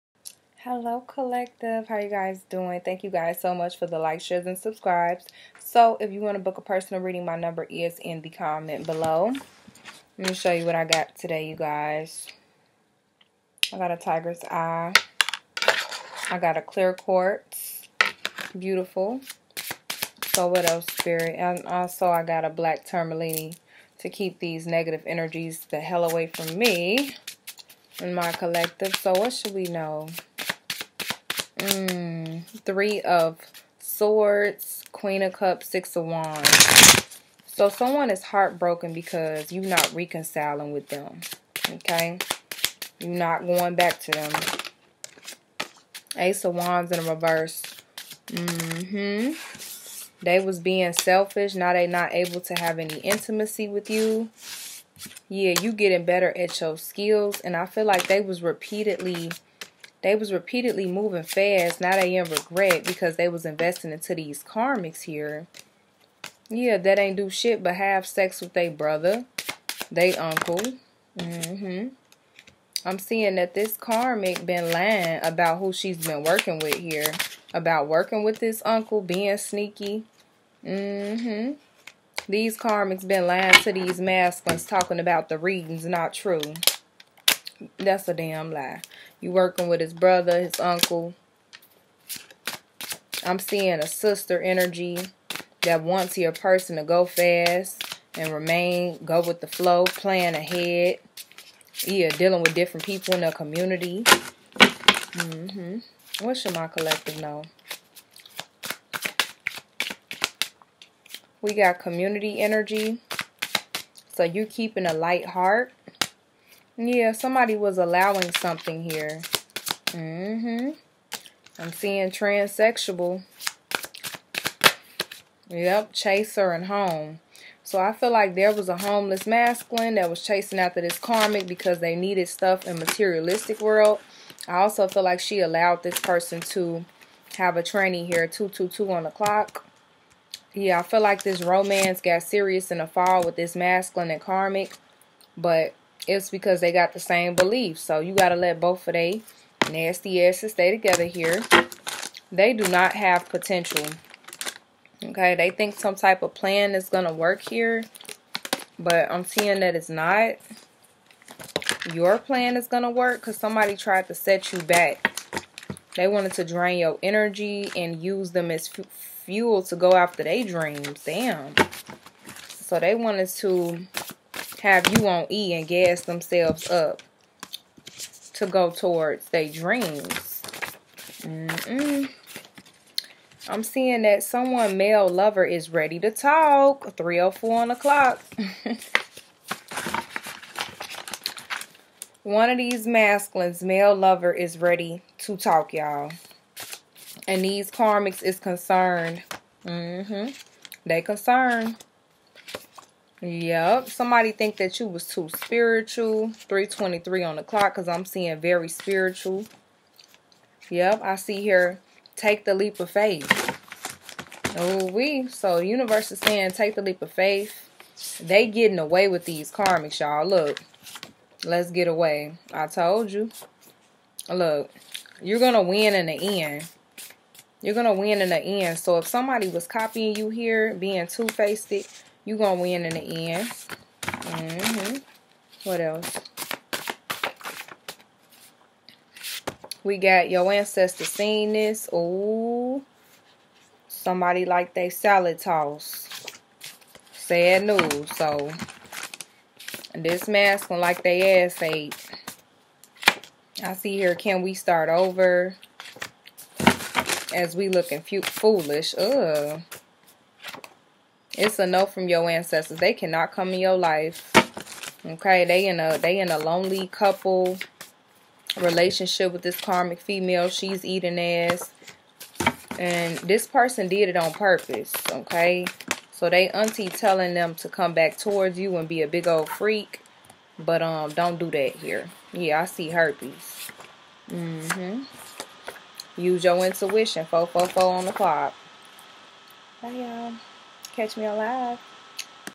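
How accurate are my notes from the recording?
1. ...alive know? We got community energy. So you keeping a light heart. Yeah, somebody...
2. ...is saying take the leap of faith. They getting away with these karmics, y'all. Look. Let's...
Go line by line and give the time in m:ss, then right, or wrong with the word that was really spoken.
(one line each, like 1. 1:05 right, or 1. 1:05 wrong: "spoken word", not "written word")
1. 1:46 wrong: "collective", not "alive"
2. 3:36 right.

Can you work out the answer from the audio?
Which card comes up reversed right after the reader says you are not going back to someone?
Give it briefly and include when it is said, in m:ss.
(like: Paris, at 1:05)
Ace of Wands, at 0:46.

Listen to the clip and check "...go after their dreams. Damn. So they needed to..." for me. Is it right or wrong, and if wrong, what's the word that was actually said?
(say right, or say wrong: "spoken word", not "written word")
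wrong: "wanted", not "needed".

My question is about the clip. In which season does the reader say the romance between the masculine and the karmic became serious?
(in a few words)
fall.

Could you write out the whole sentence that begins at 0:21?
And also, I got a black tourmaline to keep these negative energies the hell away from me and my collective.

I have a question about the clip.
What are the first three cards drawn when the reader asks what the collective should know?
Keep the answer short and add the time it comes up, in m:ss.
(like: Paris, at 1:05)
Three of Swords, Queen of Cups, Six of Wands, at 0:32.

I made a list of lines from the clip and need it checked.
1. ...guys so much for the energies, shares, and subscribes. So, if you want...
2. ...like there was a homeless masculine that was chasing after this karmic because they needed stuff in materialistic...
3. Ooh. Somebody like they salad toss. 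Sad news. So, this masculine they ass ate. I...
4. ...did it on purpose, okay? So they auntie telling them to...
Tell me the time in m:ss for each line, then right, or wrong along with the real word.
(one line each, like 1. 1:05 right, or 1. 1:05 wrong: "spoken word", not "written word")
1. 0:03 wrong: "likes", not "energies"
2. 2:08 right
3. 4:01 right
4. 4:33 right.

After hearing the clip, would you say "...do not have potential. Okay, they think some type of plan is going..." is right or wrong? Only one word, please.
right.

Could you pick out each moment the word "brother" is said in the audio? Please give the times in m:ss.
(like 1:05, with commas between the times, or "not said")
1:08, 1:29.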